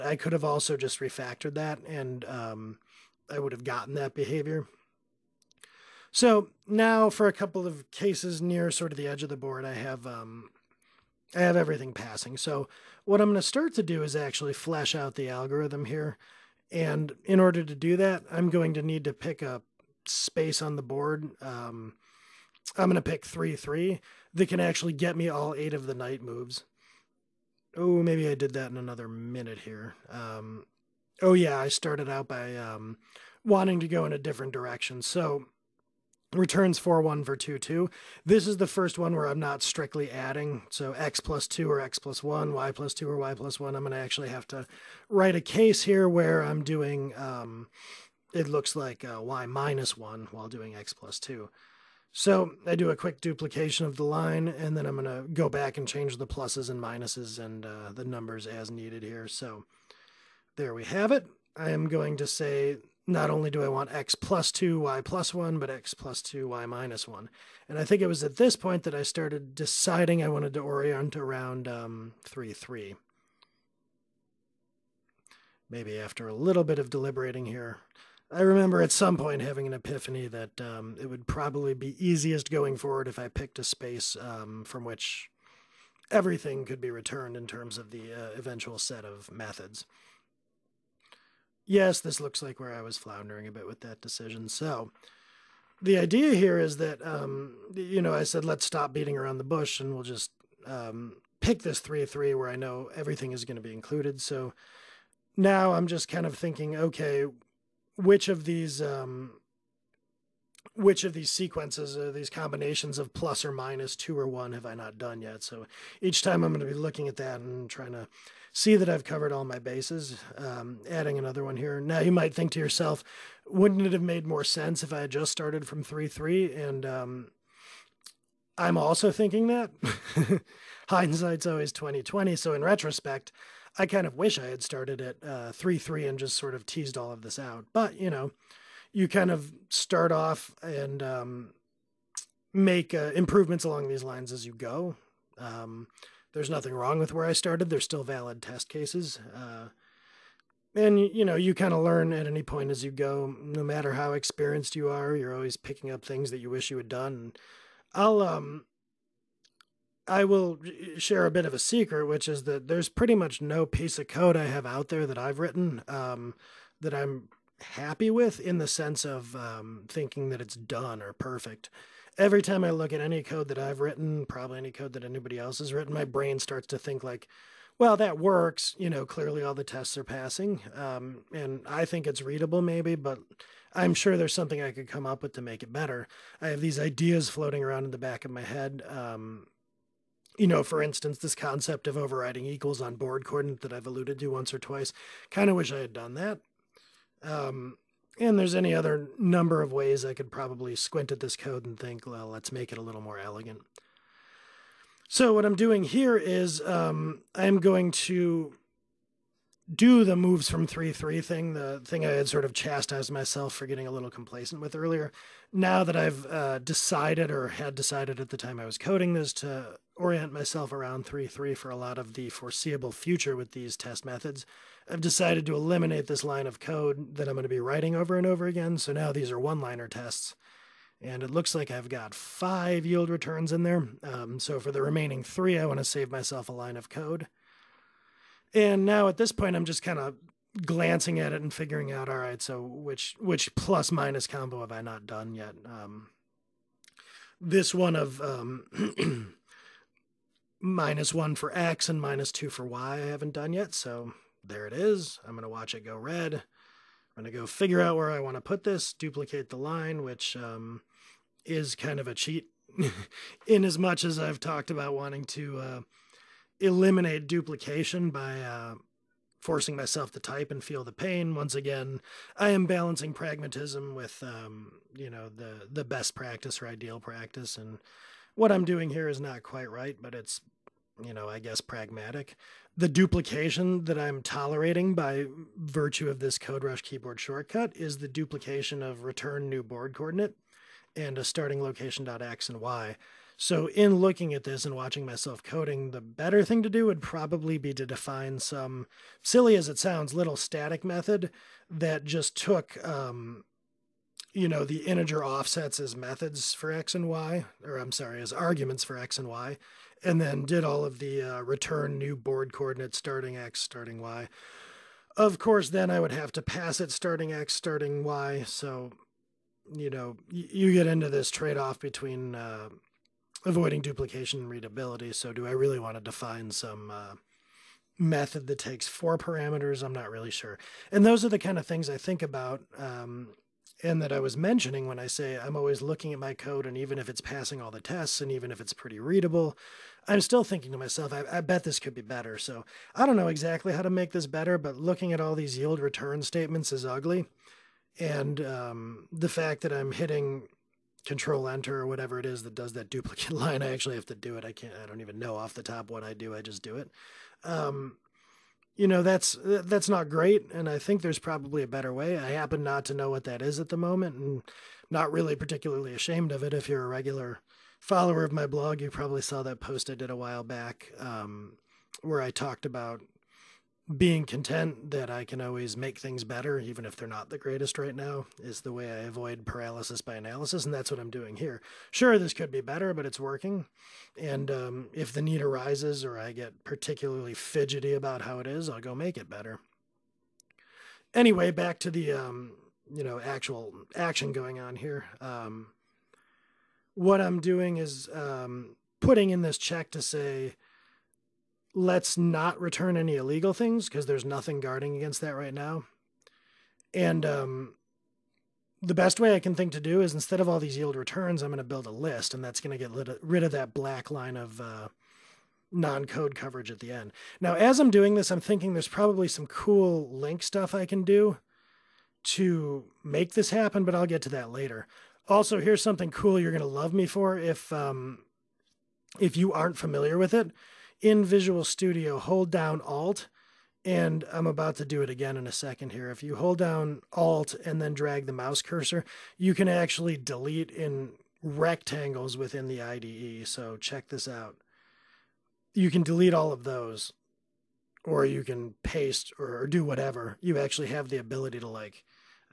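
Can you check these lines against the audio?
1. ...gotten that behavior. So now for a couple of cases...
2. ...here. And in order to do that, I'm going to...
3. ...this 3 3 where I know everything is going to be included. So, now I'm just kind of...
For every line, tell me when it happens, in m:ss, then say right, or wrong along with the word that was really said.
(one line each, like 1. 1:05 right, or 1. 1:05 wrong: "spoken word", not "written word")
1. 0:03 right
2. 0:15 right
3. 1:41 right.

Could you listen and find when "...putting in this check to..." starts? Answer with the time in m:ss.
6:38.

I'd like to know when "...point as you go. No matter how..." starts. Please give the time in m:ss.
2:32.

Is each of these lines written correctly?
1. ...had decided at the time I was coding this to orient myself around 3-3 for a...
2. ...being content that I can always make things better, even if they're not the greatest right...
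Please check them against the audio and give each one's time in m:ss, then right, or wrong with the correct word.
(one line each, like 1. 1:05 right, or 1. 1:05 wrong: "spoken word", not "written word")
1. 3:37 right
2. 6:13 right.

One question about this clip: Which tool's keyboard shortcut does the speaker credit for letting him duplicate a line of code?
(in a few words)
CodeRush.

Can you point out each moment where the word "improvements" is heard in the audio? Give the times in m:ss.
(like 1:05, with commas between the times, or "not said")
2:23.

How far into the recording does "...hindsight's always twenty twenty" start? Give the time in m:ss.
2:10.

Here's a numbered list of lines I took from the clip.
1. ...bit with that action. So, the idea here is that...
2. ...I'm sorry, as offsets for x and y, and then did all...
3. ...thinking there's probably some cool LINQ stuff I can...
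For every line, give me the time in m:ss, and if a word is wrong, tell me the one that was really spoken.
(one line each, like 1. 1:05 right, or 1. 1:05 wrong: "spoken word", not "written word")
1. 1:33 wrong: "decision", not "action"
2. 5:07 wrong: "arguments", not "offsets"
3. 6:58 right.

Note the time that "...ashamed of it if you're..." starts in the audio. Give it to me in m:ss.
6:05.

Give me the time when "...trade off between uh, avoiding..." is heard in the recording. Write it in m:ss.
5:21.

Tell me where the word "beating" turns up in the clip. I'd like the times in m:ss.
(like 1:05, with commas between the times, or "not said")
1:38.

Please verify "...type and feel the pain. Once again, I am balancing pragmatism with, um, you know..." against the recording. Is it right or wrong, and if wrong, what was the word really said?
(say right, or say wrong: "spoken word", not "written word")
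right.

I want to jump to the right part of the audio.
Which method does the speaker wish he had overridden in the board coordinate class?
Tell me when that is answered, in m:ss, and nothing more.
3:12.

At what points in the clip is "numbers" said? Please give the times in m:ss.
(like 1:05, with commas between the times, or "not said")
0:58, 3:19.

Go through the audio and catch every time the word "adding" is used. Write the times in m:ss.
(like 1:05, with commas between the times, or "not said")
0:40, 2:00.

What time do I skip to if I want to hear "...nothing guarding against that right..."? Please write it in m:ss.
6:44.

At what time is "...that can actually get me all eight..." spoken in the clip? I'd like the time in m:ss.
0:24.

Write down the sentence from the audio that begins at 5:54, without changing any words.
I can't, I don't even know off the top what I do.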